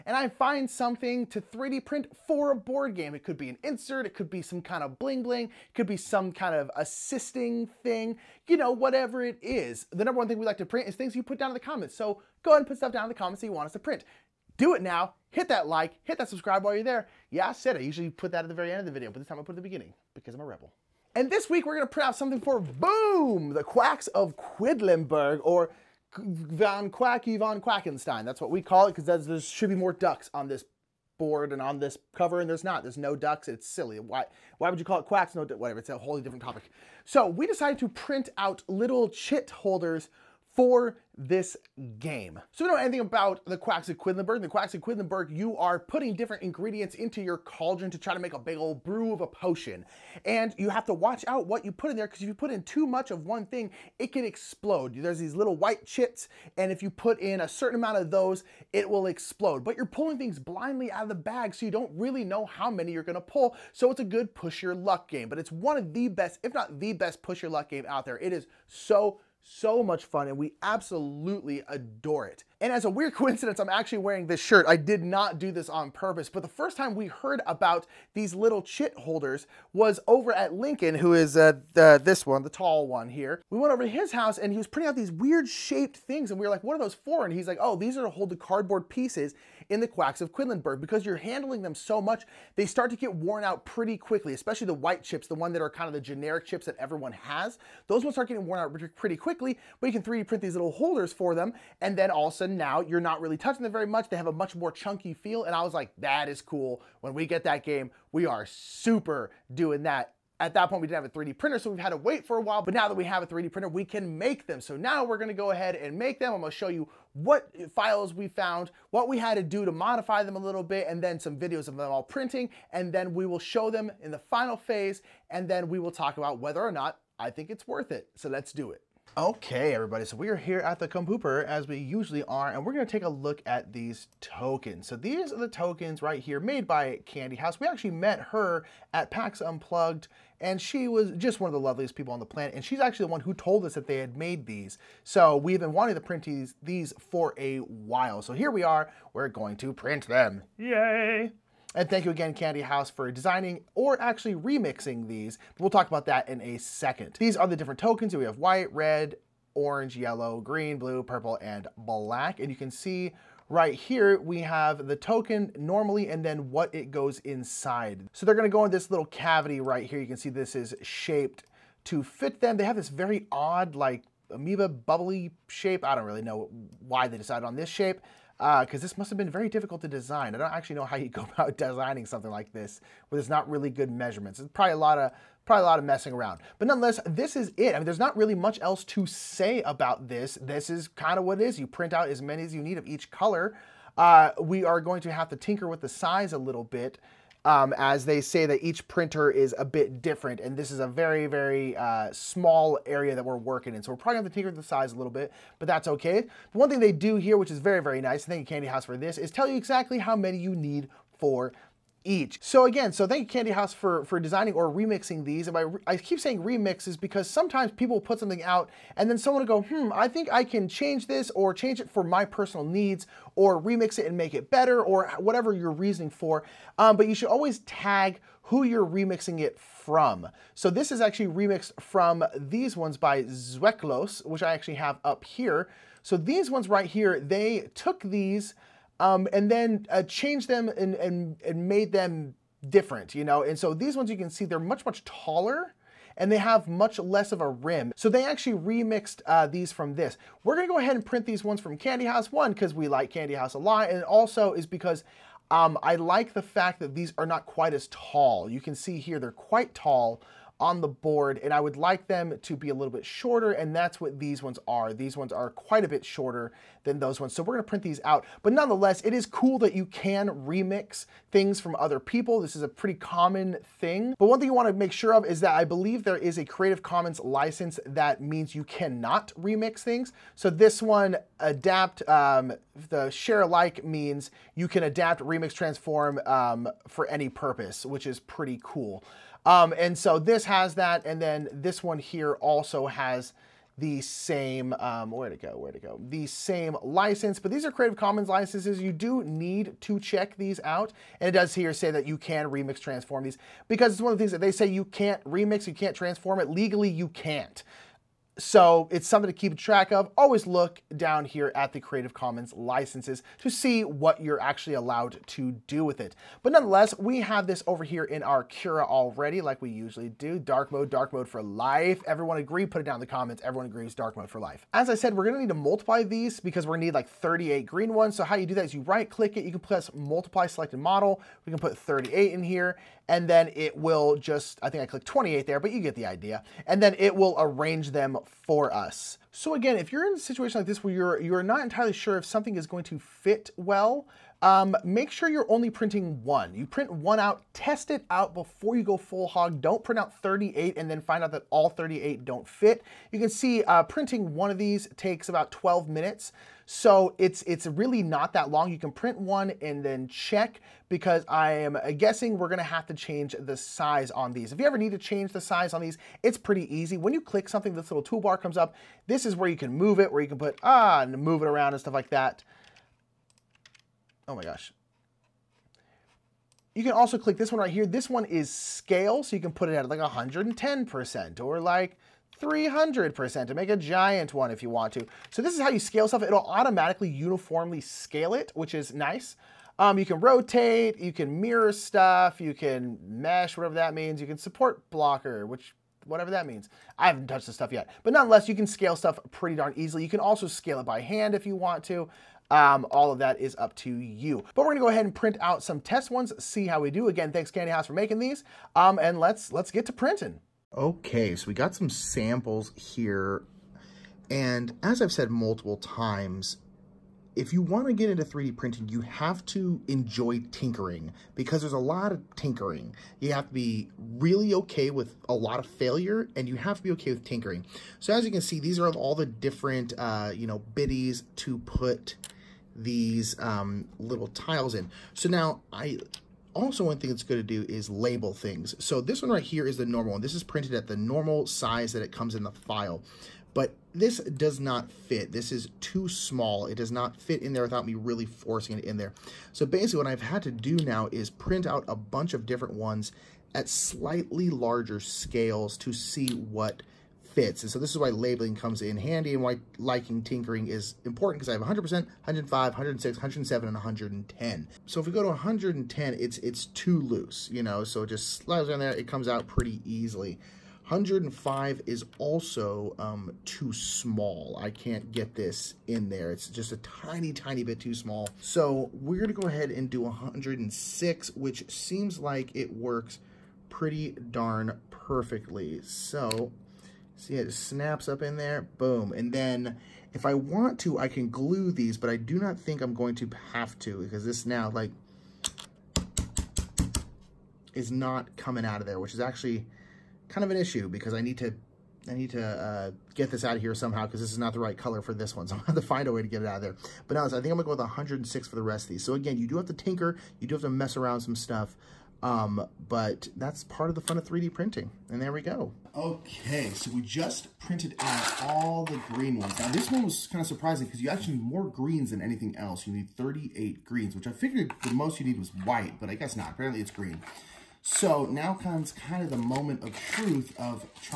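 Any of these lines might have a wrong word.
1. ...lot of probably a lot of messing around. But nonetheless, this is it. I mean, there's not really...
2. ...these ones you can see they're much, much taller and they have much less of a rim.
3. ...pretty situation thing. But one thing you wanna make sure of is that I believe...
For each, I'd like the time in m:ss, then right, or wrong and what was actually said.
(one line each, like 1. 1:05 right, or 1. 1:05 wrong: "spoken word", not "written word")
1. 3:04 right
2. 4:03 right
3. 4:32 wrong: "common", not "situation".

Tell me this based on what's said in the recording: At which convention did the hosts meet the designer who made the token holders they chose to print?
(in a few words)
PAX Unplugged.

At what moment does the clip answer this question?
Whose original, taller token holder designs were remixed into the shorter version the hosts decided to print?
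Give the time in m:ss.
3:53.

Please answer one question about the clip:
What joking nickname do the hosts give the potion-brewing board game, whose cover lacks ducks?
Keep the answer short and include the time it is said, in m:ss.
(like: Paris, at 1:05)
Von Quacky von Quackenstein, at 0:26.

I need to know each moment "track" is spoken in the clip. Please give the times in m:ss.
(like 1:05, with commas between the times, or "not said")
5:09.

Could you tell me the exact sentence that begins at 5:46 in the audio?
You print one out, test it out before you go full hog.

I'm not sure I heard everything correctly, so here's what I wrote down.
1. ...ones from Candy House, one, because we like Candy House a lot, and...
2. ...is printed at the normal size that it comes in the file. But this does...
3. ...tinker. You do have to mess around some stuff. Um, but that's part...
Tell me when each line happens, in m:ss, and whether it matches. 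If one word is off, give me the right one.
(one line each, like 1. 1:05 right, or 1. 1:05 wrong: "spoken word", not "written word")
1. 4:11 right
2. 7:20 right
3. 8:29 right.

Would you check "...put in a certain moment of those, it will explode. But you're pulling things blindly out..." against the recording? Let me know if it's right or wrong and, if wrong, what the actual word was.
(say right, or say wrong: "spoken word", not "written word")
wrong: "amount", not "moment".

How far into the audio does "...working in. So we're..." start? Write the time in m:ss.
3:23.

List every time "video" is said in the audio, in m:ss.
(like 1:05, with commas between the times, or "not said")
0:18, 2:01.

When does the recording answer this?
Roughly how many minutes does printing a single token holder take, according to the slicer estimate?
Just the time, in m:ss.
5:55.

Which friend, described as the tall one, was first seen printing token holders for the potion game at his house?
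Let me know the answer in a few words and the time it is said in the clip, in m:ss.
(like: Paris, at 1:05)
Lincoln, at 1:20.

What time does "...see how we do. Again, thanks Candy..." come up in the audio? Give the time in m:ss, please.
6:46.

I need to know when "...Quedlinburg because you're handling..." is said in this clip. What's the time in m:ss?
1:30.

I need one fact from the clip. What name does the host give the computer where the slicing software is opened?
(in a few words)
Compooper.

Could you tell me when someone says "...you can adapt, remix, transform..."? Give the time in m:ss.
4:44.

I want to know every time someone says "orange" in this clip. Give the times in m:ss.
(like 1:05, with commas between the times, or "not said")
2:39.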